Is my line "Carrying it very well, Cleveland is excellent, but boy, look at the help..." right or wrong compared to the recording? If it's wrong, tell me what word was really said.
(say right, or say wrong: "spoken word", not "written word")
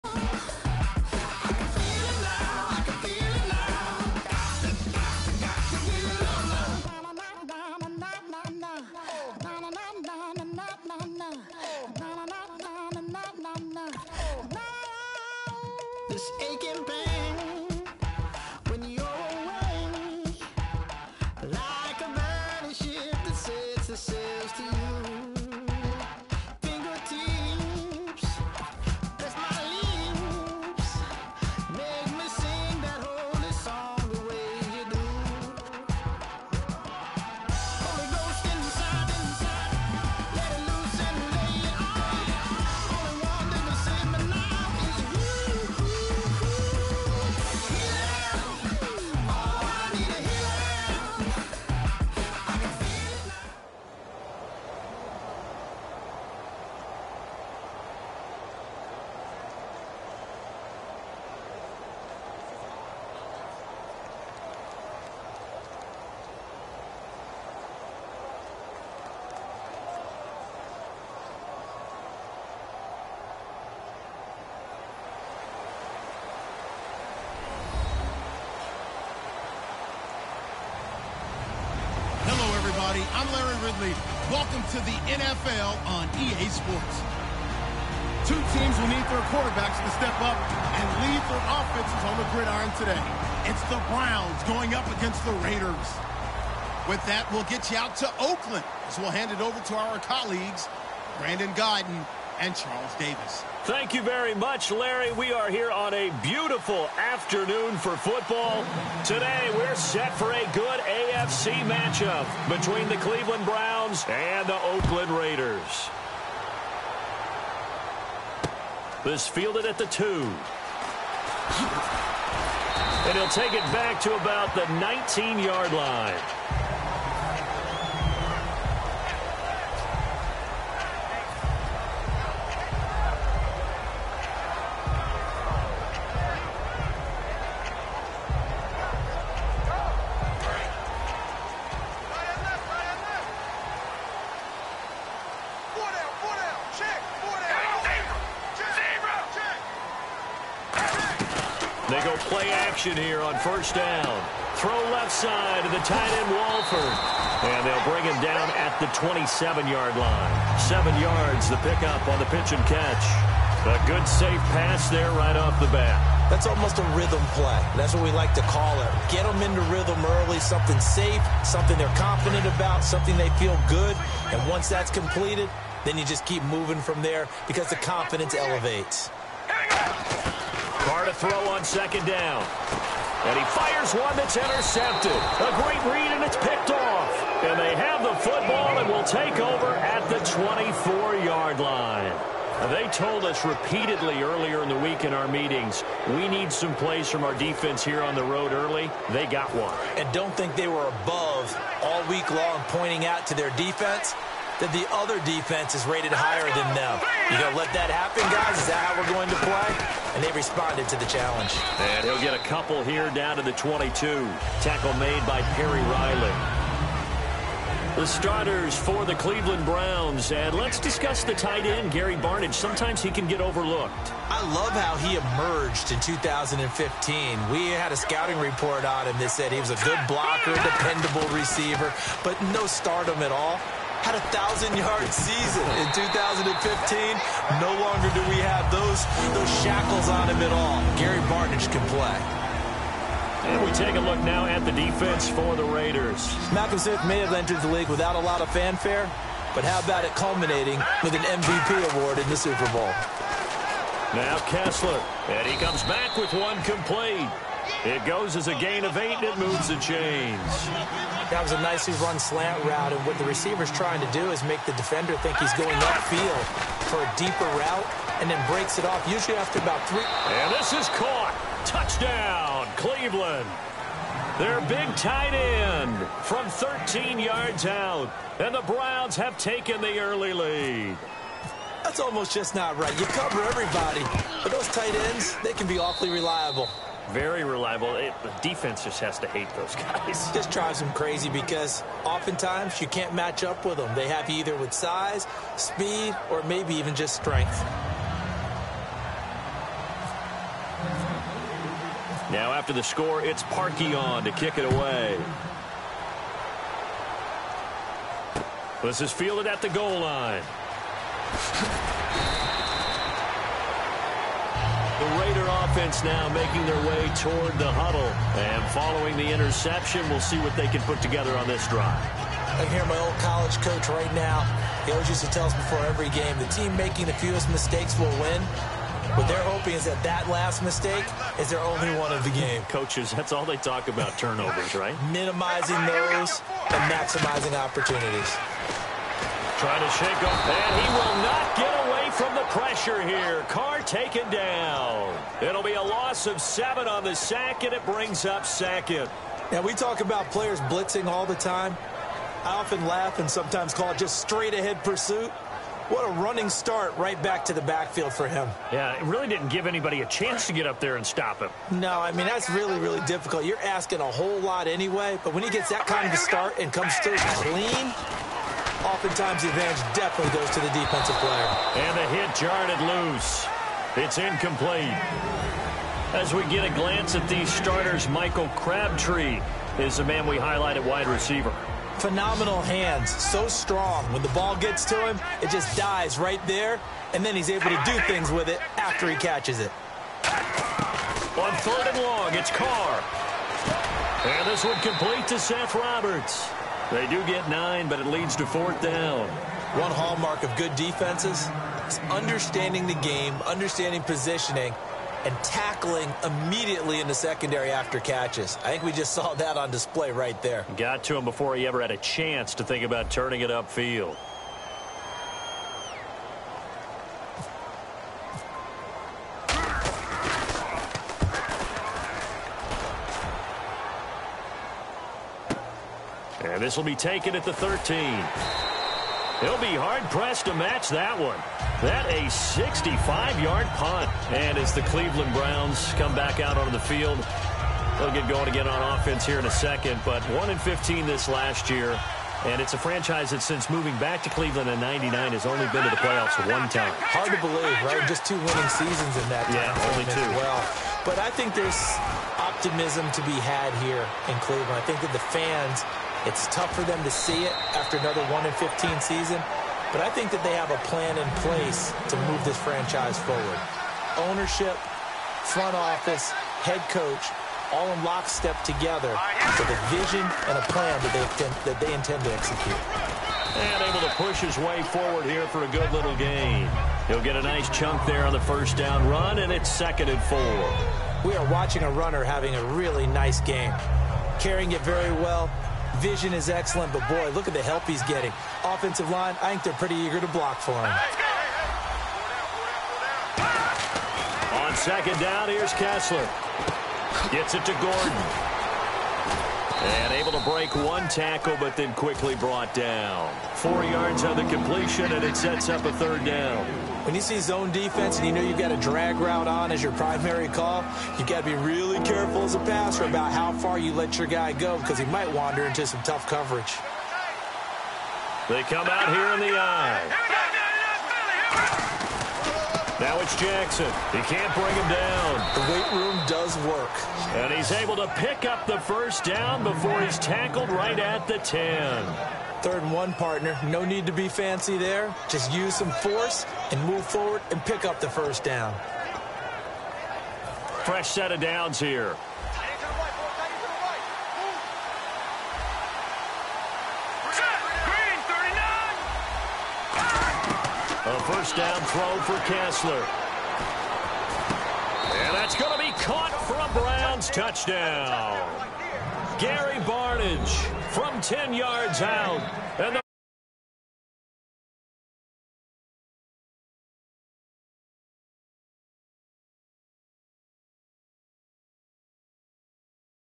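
wrong: "Vision", not "Cleveland".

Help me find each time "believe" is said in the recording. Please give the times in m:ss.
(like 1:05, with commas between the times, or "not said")
7:27.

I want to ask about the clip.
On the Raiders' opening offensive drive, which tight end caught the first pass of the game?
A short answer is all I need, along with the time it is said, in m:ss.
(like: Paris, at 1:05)
Walford, at 2:36.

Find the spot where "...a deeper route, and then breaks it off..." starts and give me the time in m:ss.
4:27.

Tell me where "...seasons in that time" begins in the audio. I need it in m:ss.
7:28.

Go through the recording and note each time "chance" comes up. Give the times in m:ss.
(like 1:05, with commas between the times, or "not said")
6:00, 6:51.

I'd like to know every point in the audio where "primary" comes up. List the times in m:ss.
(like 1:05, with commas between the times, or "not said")
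8:29.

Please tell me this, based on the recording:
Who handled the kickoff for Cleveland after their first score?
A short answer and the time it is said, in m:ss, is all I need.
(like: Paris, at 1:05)
Parkey, at 5:03.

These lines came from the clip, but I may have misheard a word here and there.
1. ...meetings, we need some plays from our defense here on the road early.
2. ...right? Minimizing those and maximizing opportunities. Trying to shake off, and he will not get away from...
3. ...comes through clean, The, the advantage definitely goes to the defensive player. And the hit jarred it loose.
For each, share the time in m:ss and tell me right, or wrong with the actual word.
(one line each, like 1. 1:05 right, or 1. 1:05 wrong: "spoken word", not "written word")
1. 3:15 right
2. 5:34 right
3. 6:06 wrong: "Oftentimes", not "The".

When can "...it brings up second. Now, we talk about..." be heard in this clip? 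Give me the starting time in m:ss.
5:47.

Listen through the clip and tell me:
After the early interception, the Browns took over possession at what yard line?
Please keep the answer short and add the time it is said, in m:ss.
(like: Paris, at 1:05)
24, at 3:10.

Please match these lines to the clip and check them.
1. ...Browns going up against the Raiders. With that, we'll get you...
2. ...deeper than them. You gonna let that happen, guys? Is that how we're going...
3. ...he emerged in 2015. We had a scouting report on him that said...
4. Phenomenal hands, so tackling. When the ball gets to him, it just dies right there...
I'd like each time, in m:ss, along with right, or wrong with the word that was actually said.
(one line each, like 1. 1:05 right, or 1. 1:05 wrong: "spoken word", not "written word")
1. 1:33 right
2. 3:26 wrong: "higher", not "deeper"
3. 3:44 right
4. 6:21 wrong: "strong", not "tackling".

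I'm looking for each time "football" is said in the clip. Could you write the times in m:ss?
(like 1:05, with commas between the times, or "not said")
1:47, 3:08.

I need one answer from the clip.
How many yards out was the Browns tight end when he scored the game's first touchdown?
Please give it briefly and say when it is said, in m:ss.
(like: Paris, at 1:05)
13, at 4:36.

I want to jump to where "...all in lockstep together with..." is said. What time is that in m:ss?
7:47.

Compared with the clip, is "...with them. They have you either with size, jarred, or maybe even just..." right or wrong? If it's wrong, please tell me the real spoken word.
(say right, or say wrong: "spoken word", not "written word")
wrong: "speed", not "jarred".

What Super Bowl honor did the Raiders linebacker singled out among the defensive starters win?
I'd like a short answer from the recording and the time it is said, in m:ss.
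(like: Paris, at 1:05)
MVP award, at 4:11.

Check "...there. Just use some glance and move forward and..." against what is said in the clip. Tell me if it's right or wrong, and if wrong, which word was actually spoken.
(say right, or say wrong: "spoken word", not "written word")
wrong: "force", not "glance".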